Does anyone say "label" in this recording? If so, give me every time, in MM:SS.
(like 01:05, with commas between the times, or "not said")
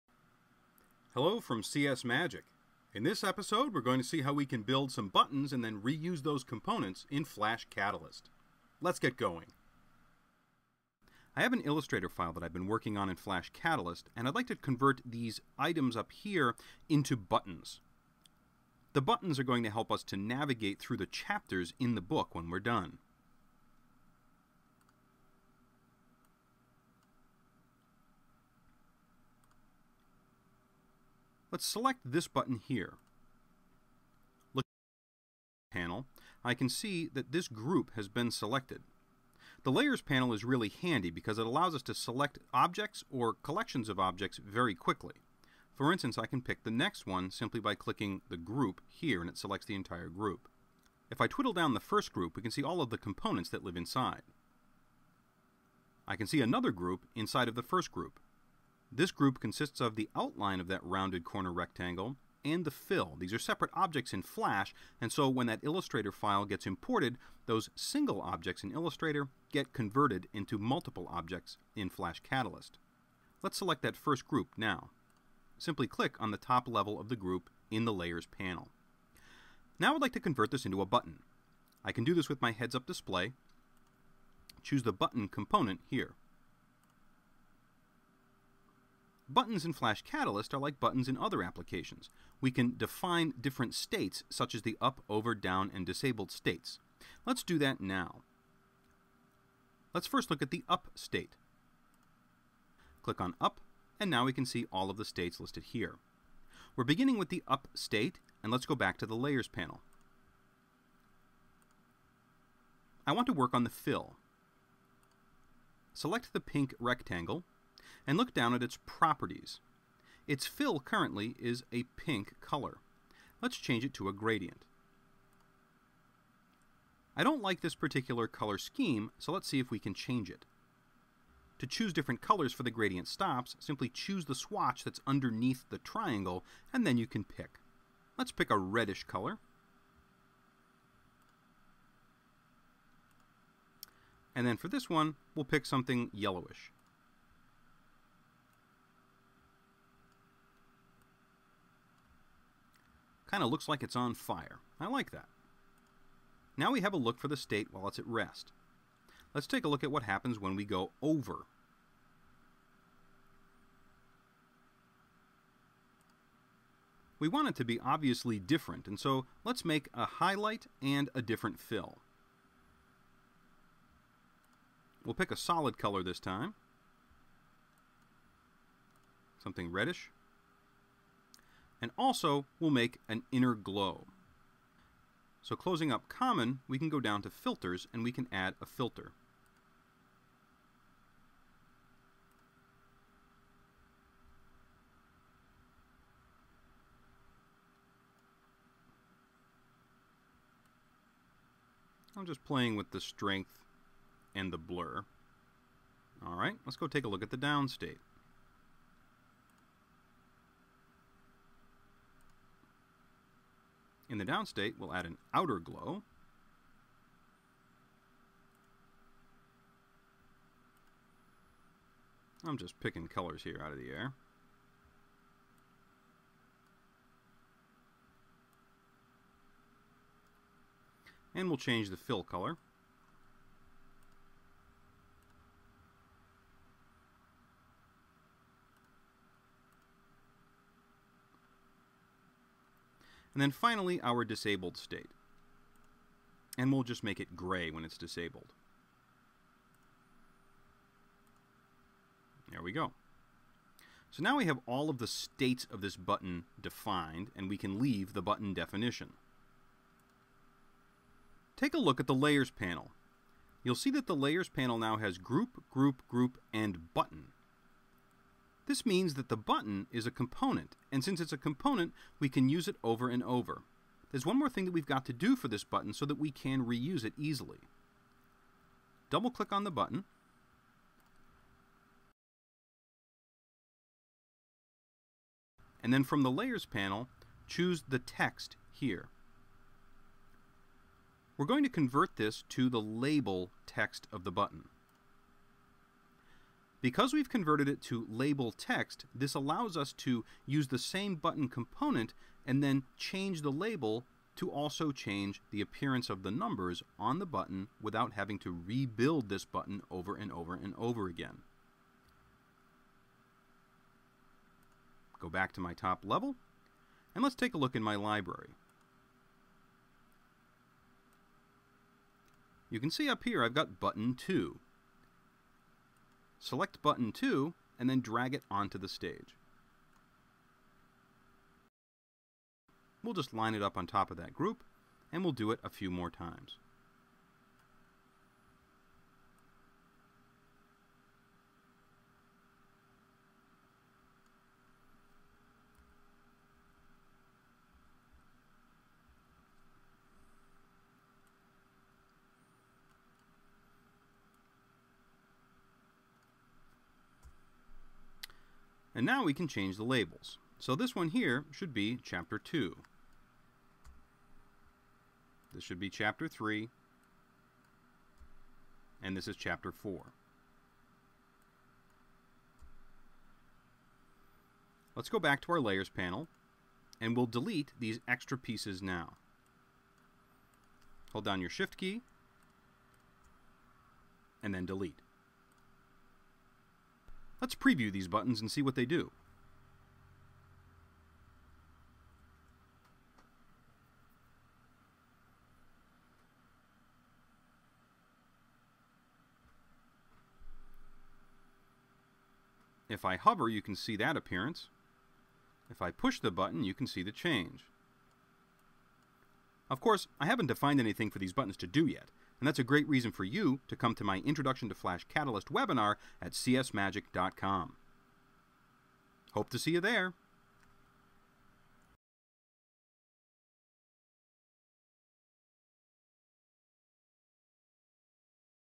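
04:52, 04:58, 05:03, 05:59.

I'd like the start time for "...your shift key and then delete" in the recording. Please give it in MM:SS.
06:21.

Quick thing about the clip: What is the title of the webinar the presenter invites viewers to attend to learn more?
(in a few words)
Introduction to Flash Catalyst.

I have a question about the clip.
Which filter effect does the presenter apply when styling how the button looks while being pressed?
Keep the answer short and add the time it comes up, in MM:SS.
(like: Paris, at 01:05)
outer glow, at 03:35.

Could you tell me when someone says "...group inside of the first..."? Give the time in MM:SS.
00:56.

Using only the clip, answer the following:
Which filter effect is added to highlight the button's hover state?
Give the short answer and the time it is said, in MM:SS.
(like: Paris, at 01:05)
inner glow, at 03:03.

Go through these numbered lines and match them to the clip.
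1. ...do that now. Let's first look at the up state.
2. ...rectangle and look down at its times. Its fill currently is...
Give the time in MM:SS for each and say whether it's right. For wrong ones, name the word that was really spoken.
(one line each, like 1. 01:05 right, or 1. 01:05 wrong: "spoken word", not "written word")
1. 01:37 right
2. 01:56 wrong: "properties", not "times".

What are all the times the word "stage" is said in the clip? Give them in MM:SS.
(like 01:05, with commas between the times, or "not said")
05:28.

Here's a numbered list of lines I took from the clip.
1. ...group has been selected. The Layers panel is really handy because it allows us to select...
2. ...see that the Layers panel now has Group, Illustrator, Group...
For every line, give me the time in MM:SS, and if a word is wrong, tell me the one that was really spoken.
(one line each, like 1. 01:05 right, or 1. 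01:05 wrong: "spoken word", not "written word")
1. 00:37 right
2. 04:23 wrong: "Group", not "Illustrator".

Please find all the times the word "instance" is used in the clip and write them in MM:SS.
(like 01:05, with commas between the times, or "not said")
00:45.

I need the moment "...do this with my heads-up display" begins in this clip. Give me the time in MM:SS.
01:22.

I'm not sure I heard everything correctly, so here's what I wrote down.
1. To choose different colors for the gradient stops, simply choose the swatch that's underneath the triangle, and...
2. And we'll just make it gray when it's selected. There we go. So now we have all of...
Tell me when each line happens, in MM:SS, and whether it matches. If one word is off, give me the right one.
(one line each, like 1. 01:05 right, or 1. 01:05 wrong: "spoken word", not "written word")
1. 02:11 right
2. 04:06 wrong: "disabled", not "selected".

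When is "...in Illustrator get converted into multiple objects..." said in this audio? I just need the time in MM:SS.
01:08.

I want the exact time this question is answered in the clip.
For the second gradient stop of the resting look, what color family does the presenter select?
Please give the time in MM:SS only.
02:25.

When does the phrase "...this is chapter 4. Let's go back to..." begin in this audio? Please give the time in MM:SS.
06:09.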